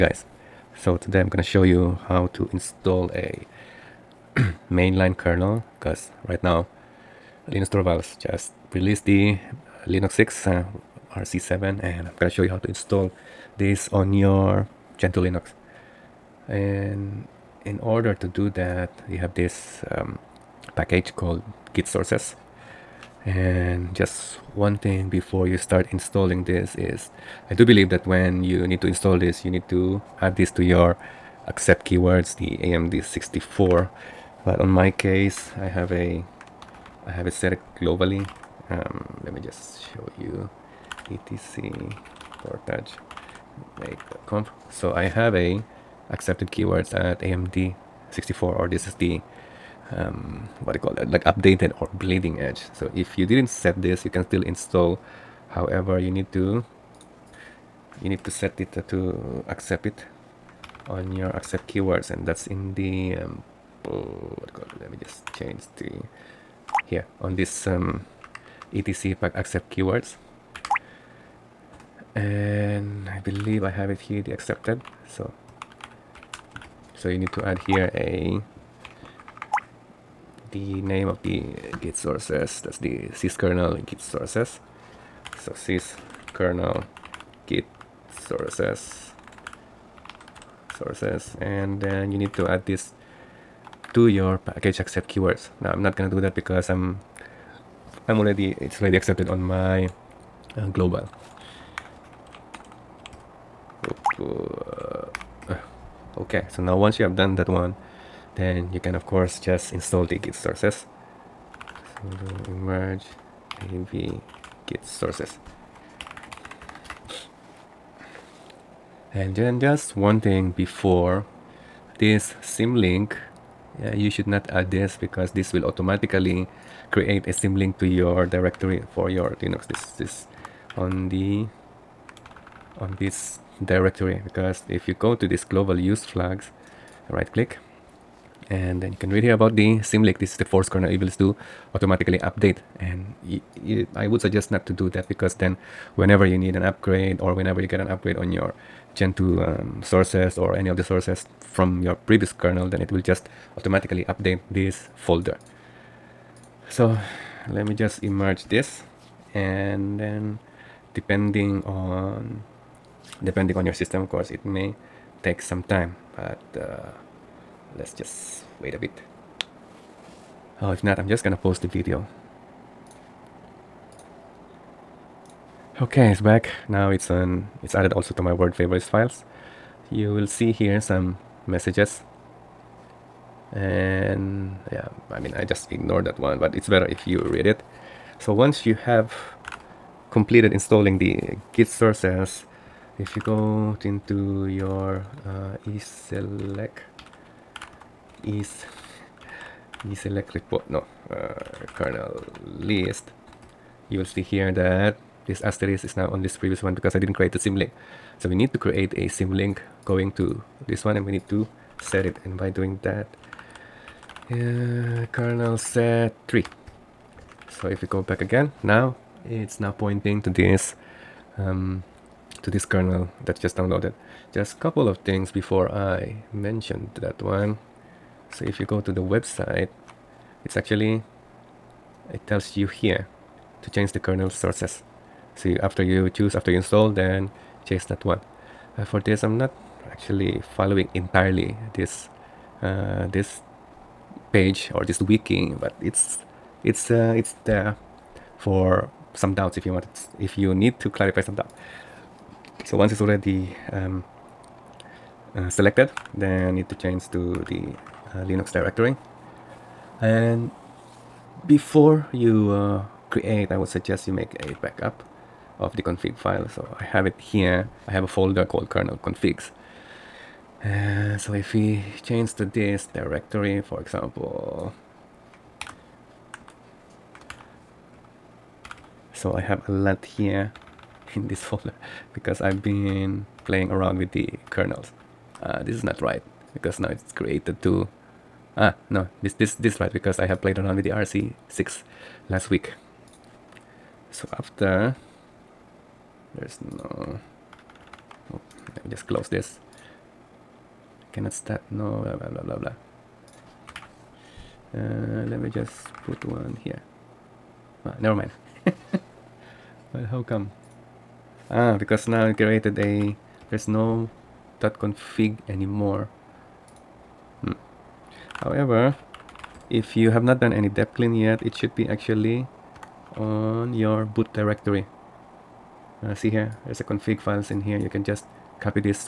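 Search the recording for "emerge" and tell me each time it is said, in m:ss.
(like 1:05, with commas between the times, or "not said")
1:52, 2:38.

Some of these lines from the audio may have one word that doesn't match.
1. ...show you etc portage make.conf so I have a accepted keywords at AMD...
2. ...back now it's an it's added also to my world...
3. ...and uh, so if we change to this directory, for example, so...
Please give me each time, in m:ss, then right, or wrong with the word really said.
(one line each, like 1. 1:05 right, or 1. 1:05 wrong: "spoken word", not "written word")
1. 0:39 right
2. 2:56 right
3. 4:30 right.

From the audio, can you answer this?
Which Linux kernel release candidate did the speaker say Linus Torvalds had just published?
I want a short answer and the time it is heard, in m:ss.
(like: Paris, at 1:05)
Linux 6 RC7, at 0:09.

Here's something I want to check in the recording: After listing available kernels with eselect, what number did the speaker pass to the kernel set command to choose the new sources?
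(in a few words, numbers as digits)
3.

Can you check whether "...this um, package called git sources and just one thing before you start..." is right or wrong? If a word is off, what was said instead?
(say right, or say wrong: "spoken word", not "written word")
right.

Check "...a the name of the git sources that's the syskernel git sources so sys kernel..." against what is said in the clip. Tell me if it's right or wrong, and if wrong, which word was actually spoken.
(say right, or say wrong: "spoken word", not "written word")
right.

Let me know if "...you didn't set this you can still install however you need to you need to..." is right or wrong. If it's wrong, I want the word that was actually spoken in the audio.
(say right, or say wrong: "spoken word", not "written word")
right.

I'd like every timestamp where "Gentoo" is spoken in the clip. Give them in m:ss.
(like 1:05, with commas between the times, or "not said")
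0:14, 2:28.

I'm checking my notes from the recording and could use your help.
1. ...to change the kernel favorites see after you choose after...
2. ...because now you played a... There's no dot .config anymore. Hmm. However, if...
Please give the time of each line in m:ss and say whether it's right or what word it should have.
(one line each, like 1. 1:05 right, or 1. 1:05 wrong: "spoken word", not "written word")
1. 3:53 wrong: "sources", not "favorites"
2. 5:11 wrong: "created", not "played".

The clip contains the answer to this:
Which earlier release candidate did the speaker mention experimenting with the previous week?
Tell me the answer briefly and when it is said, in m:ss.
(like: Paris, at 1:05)
RC6, at 4:50.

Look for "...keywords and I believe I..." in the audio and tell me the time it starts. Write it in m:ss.
1:09.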